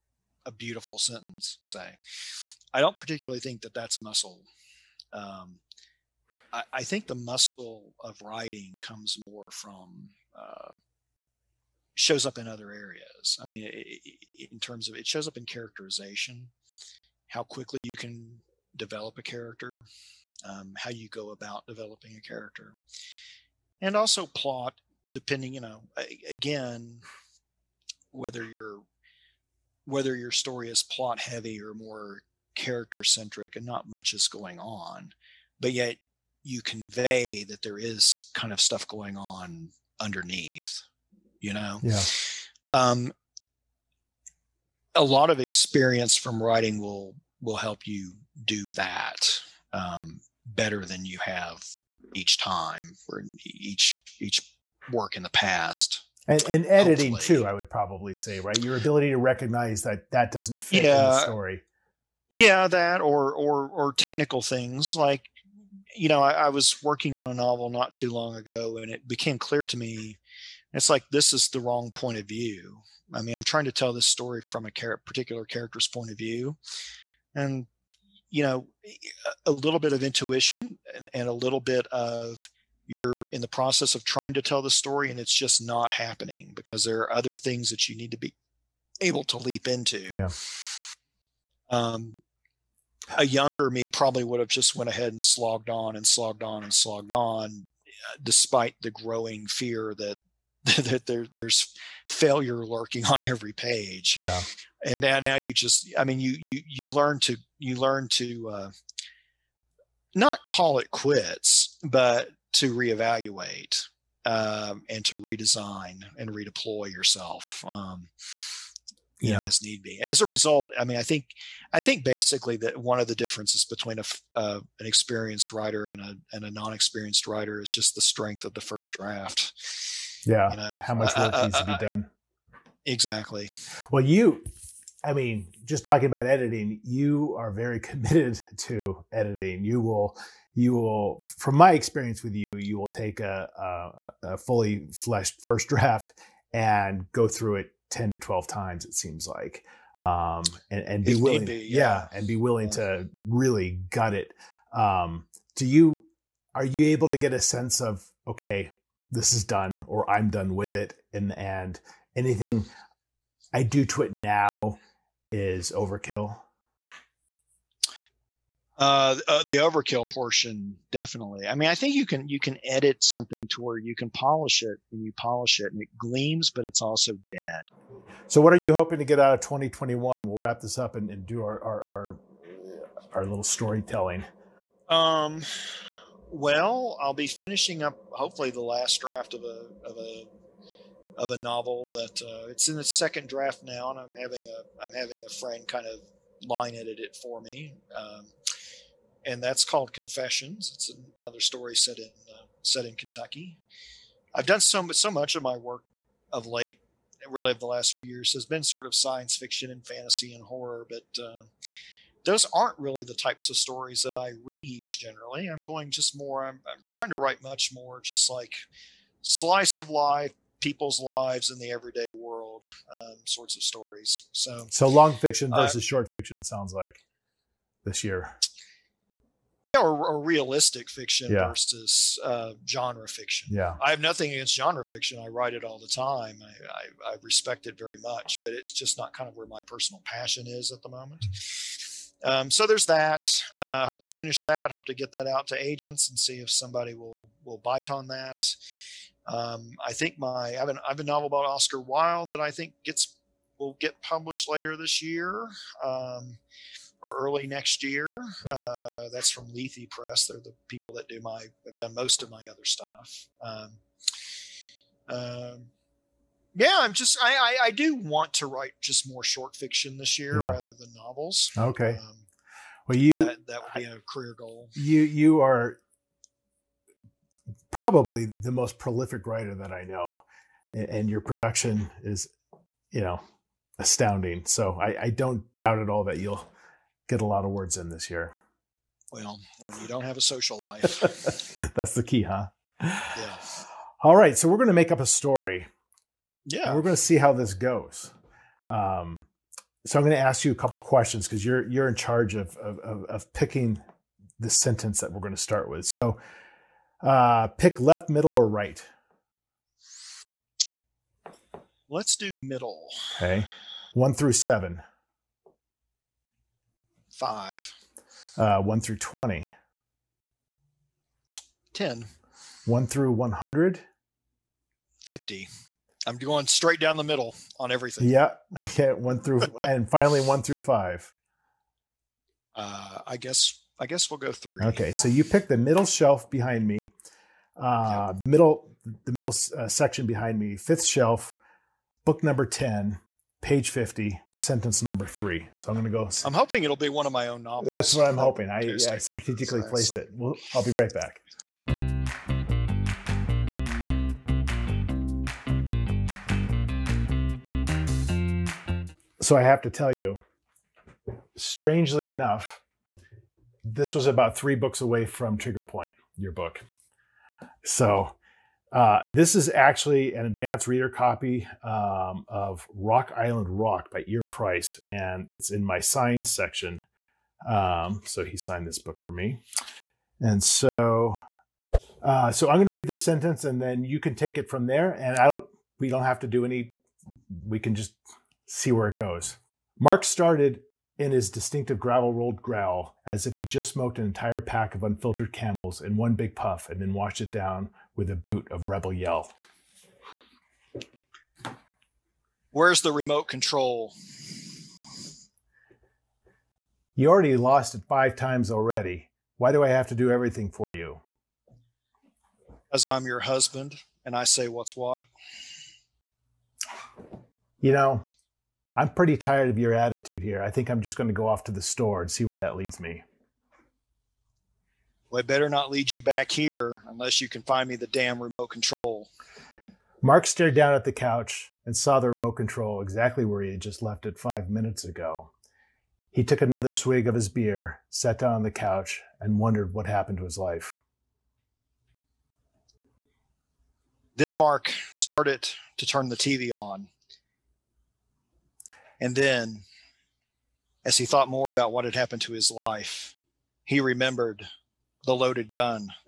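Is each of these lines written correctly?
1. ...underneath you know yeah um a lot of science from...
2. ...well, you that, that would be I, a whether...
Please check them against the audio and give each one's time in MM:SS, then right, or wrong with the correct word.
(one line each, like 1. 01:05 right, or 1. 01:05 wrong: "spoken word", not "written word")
1. 00:40 wrong: "experience", not "science"
2. 04:32 wrong: "career", not "whether".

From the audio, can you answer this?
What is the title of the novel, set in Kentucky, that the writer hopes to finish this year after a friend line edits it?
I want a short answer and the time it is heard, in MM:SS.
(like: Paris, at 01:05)
Confessions, at 03:19.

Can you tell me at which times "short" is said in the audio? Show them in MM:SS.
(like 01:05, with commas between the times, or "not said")
03:45, 04:29.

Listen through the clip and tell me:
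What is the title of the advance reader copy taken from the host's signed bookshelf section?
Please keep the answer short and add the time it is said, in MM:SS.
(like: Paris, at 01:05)
Rock Island Rock, at 06:12.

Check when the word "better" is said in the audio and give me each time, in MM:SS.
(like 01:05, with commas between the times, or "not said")
00:50, 07:05.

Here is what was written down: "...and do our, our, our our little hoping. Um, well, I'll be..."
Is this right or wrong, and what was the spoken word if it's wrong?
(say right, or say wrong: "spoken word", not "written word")
wrong: "storytelling", not "hoping".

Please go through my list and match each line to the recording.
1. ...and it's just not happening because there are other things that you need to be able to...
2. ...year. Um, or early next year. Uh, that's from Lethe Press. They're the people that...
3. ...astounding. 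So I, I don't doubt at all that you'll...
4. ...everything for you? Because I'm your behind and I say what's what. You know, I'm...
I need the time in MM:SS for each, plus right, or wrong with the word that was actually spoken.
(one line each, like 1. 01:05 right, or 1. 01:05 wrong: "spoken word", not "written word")
1. 01:25 right
2. 04:15 right
3. 04:43 right
4. 06:50 wrong: "husband", not "behind".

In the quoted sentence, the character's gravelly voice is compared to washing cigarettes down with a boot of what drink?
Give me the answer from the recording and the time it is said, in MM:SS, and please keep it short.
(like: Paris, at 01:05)
Rebel Yell, at 06:38.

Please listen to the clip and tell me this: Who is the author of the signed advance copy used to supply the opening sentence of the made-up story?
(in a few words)
Eyre Price.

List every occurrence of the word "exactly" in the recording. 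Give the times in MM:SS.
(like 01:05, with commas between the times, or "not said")
02:12, 07:12.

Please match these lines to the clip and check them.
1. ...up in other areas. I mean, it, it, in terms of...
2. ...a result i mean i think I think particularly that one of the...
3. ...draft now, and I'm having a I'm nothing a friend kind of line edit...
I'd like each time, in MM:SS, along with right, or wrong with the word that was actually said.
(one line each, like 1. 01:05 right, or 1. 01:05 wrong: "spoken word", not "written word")
1. 00:12 right
2. 02:00 wrong: "basically", not "particularly"
3. 03:13 wrong: "having", not "nothing".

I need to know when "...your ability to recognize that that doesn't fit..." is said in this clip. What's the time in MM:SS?
00:58.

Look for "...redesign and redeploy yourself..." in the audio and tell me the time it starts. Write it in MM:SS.
01:55.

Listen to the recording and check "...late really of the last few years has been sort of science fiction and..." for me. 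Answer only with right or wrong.
right.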